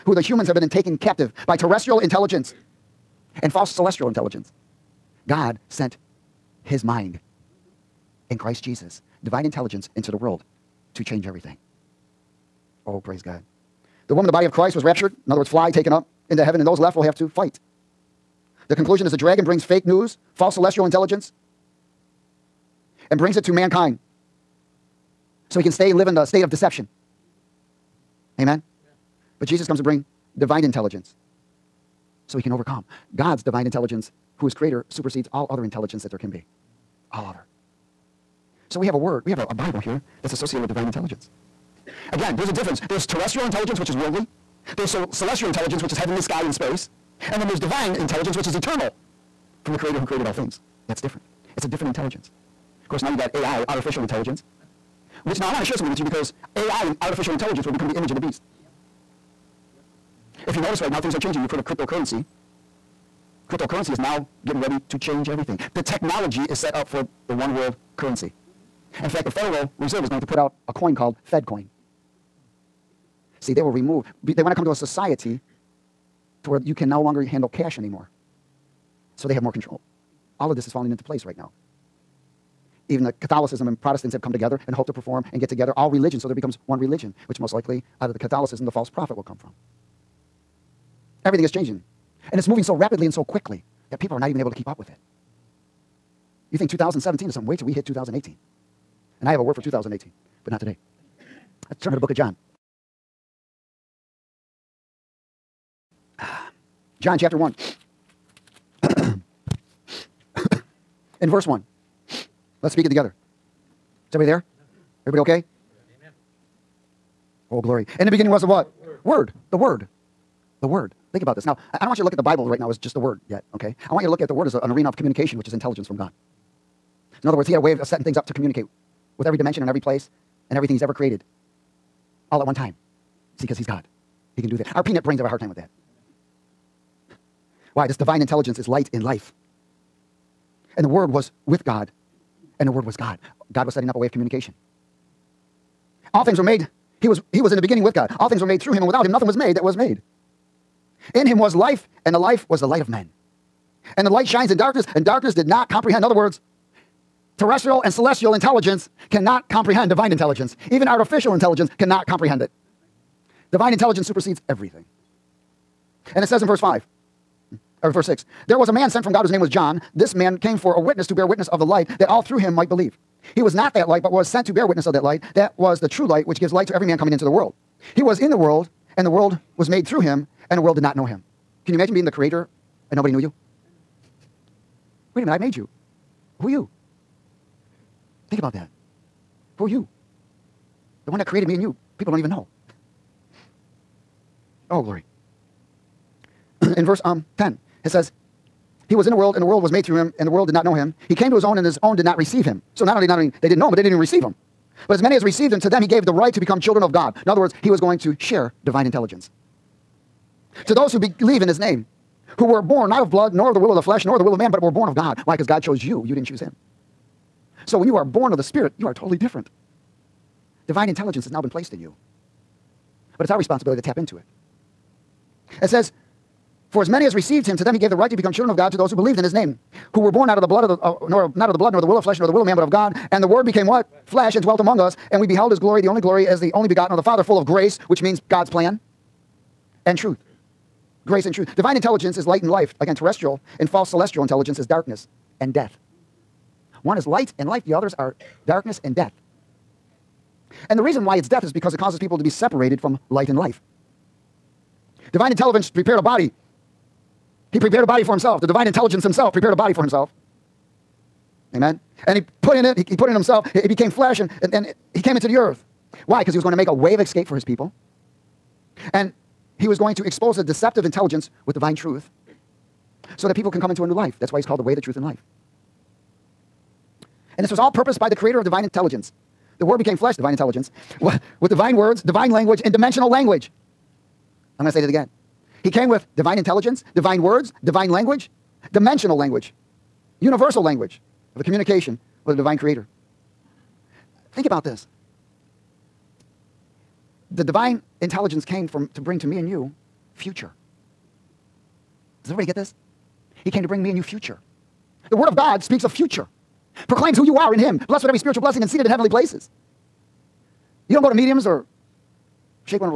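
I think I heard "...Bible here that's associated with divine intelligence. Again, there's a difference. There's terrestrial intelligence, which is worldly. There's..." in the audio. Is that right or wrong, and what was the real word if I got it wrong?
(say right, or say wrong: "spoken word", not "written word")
right.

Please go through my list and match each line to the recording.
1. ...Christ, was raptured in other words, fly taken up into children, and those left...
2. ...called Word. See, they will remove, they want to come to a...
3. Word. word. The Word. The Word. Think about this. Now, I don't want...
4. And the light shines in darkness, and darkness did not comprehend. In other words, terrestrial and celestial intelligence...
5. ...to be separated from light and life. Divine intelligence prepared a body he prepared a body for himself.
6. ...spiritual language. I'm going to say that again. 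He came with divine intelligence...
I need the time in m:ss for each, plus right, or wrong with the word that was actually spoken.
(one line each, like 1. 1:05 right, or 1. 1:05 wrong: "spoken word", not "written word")
1. 0:14 wrong: "heaven", not "children"
2. 1:10 wrong: "FedCoin", not "Word"
3. 1:58 right
4. 2:33 right
5. 4:12 right
6. 4:42 wrong: "dimensional", not "spiritual".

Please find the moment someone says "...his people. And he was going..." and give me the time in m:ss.
4:27.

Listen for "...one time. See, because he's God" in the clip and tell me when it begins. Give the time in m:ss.
2:12.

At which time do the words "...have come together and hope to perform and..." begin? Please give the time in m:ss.
1:24.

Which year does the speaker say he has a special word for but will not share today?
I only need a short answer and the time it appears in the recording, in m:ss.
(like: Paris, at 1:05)
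2018, at 1:39.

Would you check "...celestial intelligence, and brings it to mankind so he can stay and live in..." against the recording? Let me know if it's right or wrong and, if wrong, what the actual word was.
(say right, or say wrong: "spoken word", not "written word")
right.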